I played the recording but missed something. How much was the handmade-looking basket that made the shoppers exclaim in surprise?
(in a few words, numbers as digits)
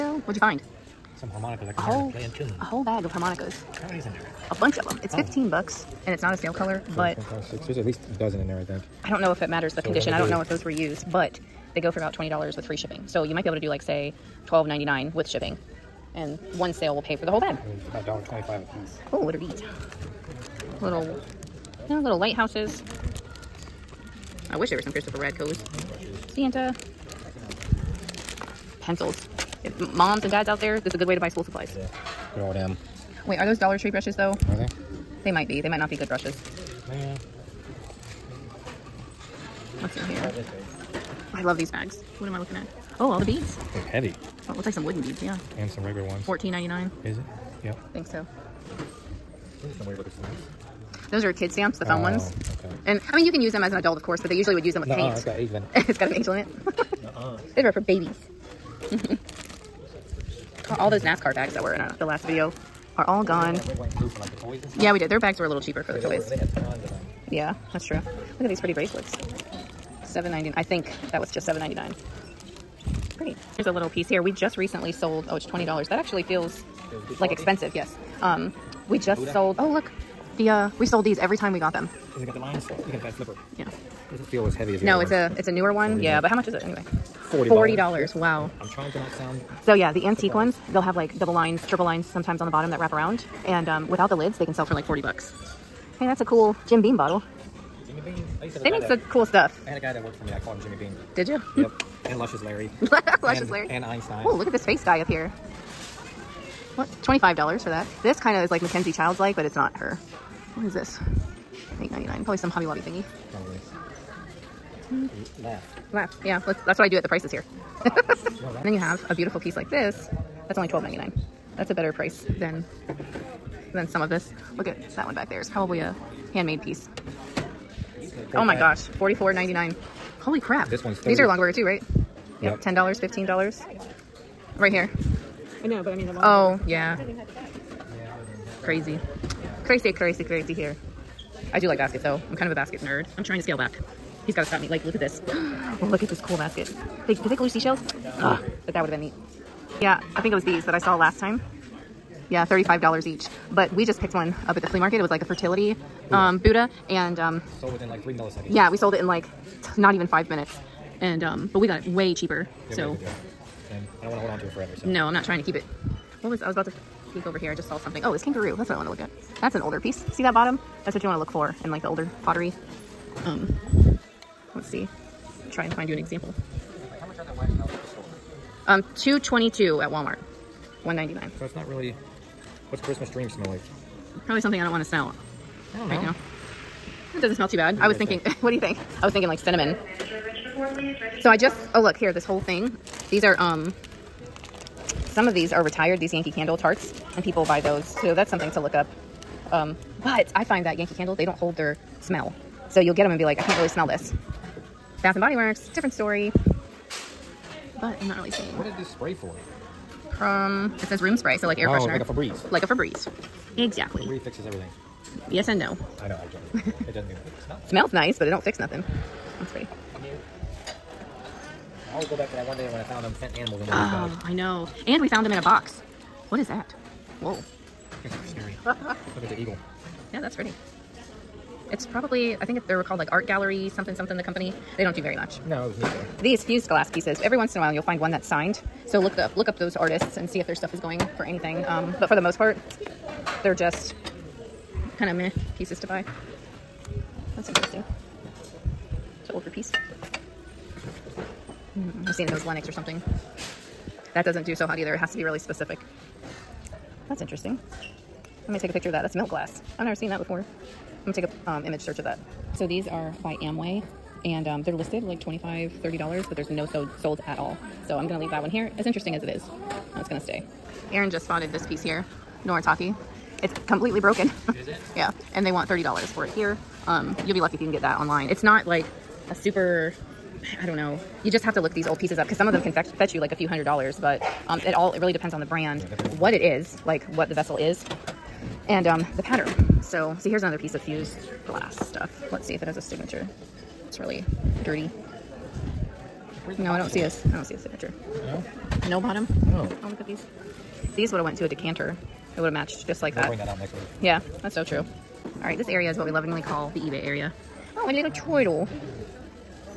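$44.99.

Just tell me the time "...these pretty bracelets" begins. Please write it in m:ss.
1:08.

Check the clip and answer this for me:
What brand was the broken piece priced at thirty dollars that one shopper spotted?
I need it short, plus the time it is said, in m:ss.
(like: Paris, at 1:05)
Noritake, at 4:32.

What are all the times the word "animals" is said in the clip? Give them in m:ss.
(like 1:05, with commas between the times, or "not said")
3:43.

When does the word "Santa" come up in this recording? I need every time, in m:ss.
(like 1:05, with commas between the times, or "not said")
0:26.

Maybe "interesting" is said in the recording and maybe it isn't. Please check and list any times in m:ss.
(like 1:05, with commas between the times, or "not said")
4:07, 4:17, 4:28.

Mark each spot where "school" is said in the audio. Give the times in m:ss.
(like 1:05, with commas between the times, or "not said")
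0:31.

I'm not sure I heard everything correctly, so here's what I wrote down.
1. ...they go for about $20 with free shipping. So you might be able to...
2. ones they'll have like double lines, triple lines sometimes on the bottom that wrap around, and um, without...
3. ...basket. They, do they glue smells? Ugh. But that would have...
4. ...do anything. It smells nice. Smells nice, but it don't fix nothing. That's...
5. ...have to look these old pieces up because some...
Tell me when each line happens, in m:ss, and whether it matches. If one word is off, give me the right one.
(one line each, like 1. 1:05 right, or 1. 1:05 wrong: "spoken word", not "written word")
1. 0:11 right
2. 1:30 right
3. 2:26 wrong: "seashells", not "smells"
4. 3:37 right
5. 4:41 right.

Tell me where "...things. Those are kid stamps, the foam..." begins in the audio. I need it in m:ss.
0:50.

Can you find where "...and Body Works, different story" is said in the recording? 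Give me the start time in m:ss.
3:25.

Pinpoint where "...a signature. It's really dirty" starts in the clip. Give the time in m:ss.
4:52.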